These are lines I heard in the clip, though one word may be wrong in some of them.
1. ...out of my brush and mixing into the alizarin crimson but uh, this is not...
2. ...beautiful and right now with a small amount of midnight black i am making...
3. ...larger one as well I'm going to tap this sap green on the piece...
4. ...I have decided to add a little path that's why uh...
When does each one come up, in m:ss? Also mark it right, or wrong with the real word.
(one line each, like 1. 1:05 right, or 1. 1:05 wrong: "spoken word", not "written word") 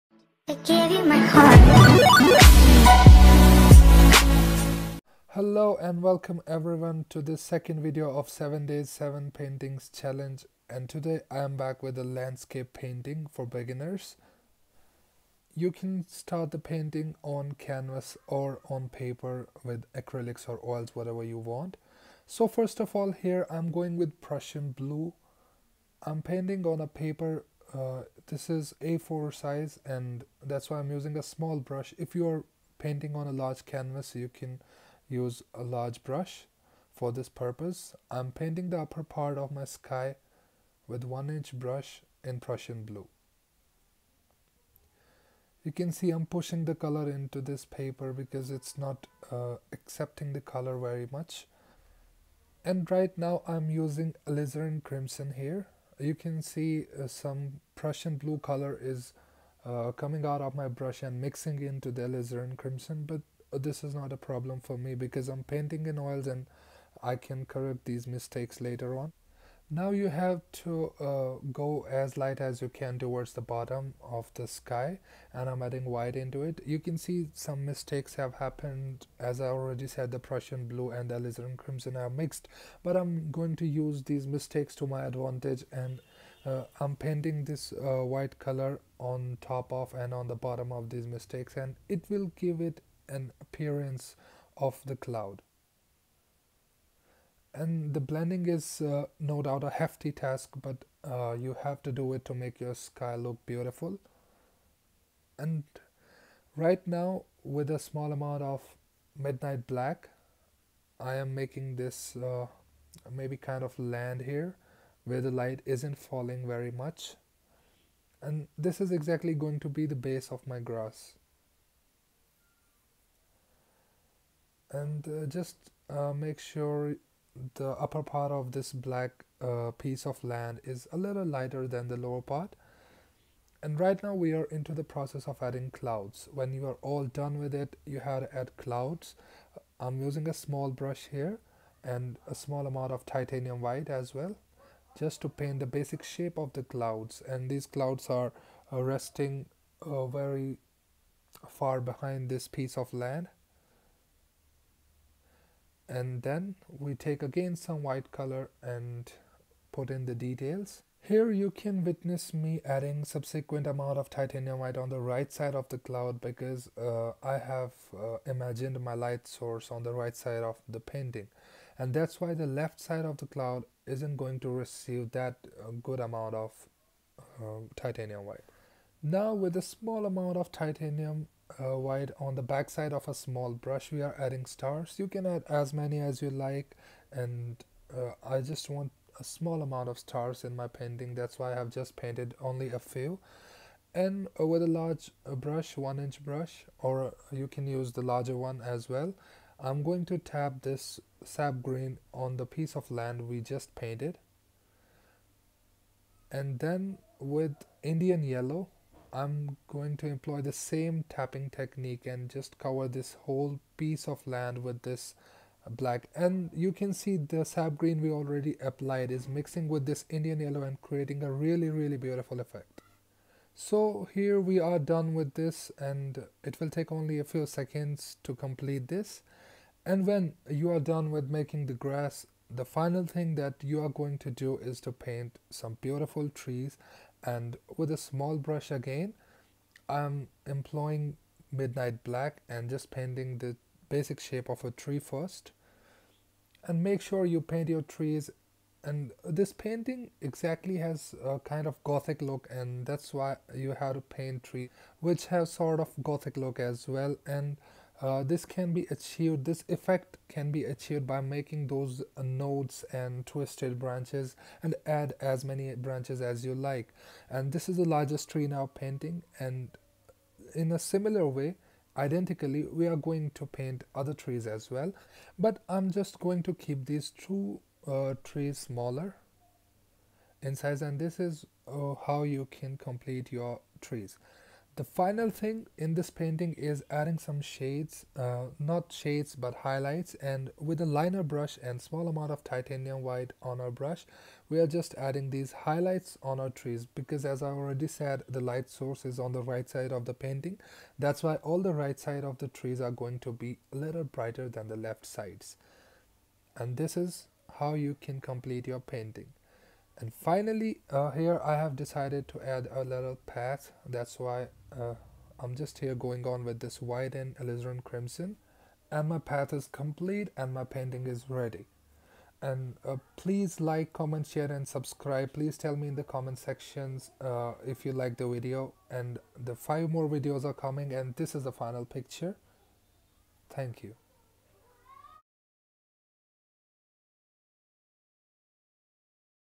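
1. 1:00 right
2. 1:43 right
3. 3:18 right
4. 5:11 right.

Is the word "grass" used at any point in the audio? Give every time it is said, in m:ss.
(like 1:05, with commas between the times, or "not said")
2:00, 3:51.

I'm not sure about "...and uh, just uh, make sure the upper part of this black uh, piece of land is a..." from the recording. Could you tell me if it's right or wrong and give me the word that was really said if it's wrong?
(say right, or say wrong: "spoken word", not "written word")
right.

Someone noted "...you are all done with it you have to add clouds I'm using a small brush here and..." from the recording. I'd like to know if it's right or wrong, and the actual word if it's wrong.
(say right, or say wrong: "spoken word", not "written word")
right.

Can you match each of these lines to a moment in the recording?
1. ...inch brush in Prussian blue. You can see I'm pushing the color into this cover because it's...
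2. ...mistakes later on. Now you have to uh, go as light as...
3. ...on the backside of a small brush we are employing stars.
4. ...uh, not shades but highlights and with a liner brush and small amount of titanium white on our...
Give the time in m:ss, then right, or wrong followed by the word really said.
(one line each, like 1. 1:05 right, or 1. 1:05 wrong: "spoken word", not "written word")
1. 0:41 wrong: "paper", not "cover"
2. 1:08 right
3. 3:02 wrong: "adding", not "employing"
4. 4:48 right.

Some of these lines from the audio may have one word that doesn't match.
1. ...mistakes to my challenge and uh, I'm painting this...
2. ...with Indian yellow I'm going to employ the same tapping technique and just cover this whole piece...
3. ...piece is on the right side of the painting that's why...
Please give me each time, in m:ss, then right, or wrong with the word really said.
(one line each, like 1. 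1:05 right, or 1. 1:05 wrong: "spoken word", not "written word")
1. 1:24 wrong: "advantage", not "challenge"
2. 3:27 right
3. 4:58 wrong: "source", not "piece".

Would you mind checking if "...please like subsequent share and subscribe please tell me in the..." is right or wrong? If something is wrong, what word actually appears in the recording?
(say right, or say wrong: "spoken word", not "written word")
wrong: "comment", not "subsequent".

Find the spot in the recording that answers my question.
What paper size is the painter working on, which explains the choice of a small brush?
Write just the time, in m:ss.
0:28.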